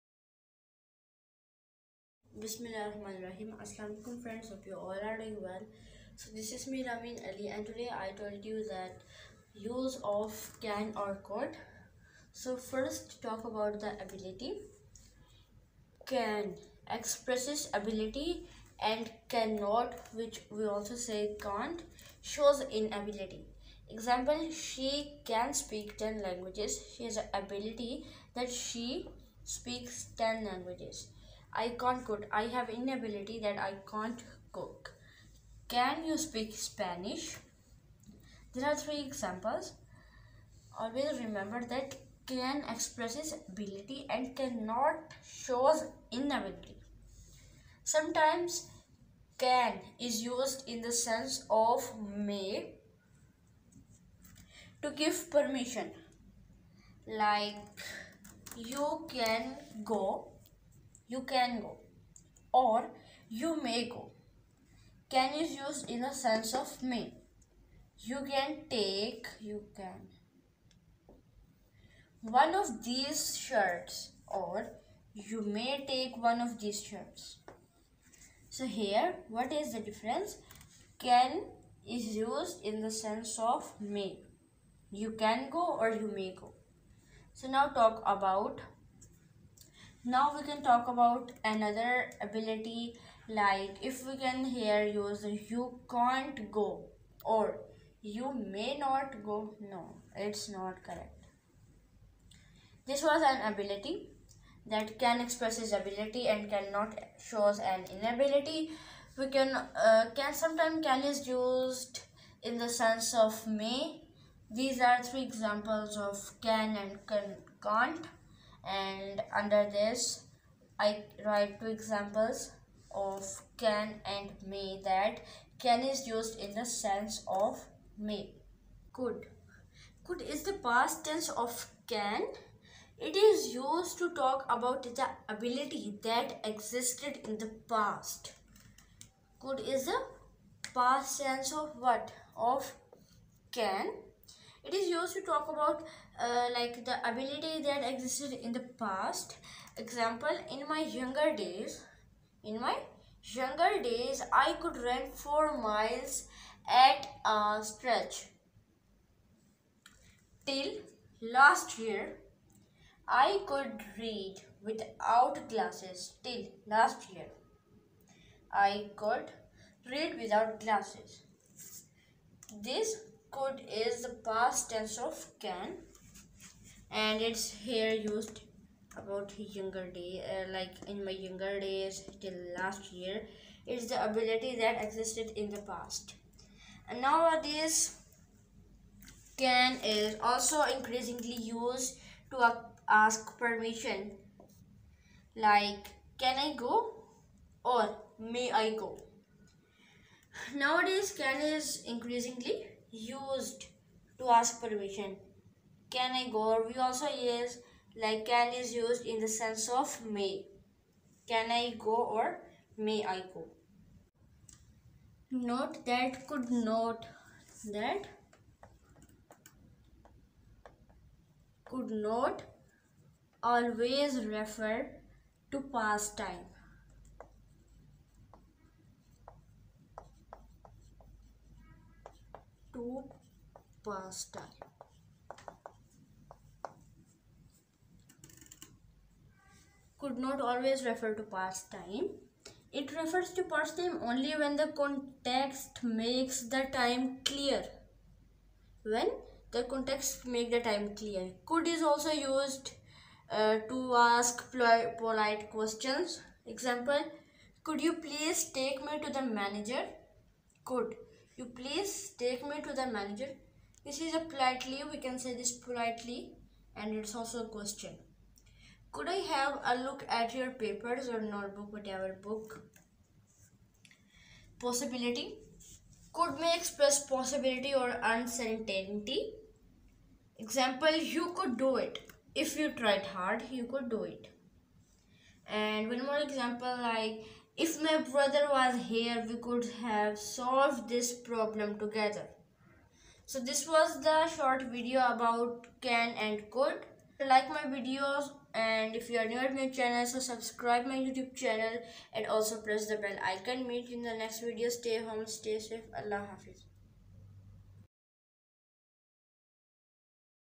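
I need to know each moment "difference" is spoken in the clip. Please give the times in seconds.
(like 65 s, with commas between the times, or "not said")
79 s.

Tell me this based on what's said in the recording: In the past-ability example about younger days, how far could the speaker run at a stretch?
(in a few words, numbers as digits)
4 miles.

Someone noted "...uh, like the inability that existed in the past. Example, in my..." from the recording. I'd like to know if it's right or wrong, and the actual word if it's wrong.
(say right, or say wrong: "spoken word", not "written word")
wrong: "ability", not "inability".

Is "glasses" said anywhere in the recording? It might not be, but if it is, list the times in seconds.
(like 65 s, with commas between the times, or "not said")
165 s, 170 s.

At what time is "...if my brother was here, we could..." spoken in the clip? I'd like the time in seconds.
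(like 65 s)
287 s.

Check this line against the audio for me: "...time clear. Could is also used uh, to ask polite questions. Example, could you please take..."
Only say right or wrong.
right.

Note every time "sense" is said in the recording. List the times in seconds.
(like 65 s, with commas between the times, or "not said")
50 s, 66 s, 82 s, 112 s, 126 s, 209 s.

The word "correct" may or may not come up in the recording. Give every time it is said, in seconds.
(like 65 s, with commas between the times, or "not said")
100 s.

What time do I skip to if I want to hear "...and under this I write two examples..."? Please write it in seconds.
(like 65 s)
118 s.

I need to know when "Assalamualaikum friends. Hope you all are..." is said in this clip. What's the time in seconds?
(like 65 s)
3 s.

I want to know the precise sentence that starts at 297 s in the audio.
Like my videos and if you are new at my channel, so subscribe my YouTube channel and also press the bell icon.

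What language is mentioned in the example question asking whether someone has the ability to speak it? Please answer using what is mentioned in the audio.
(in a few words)
Spanish.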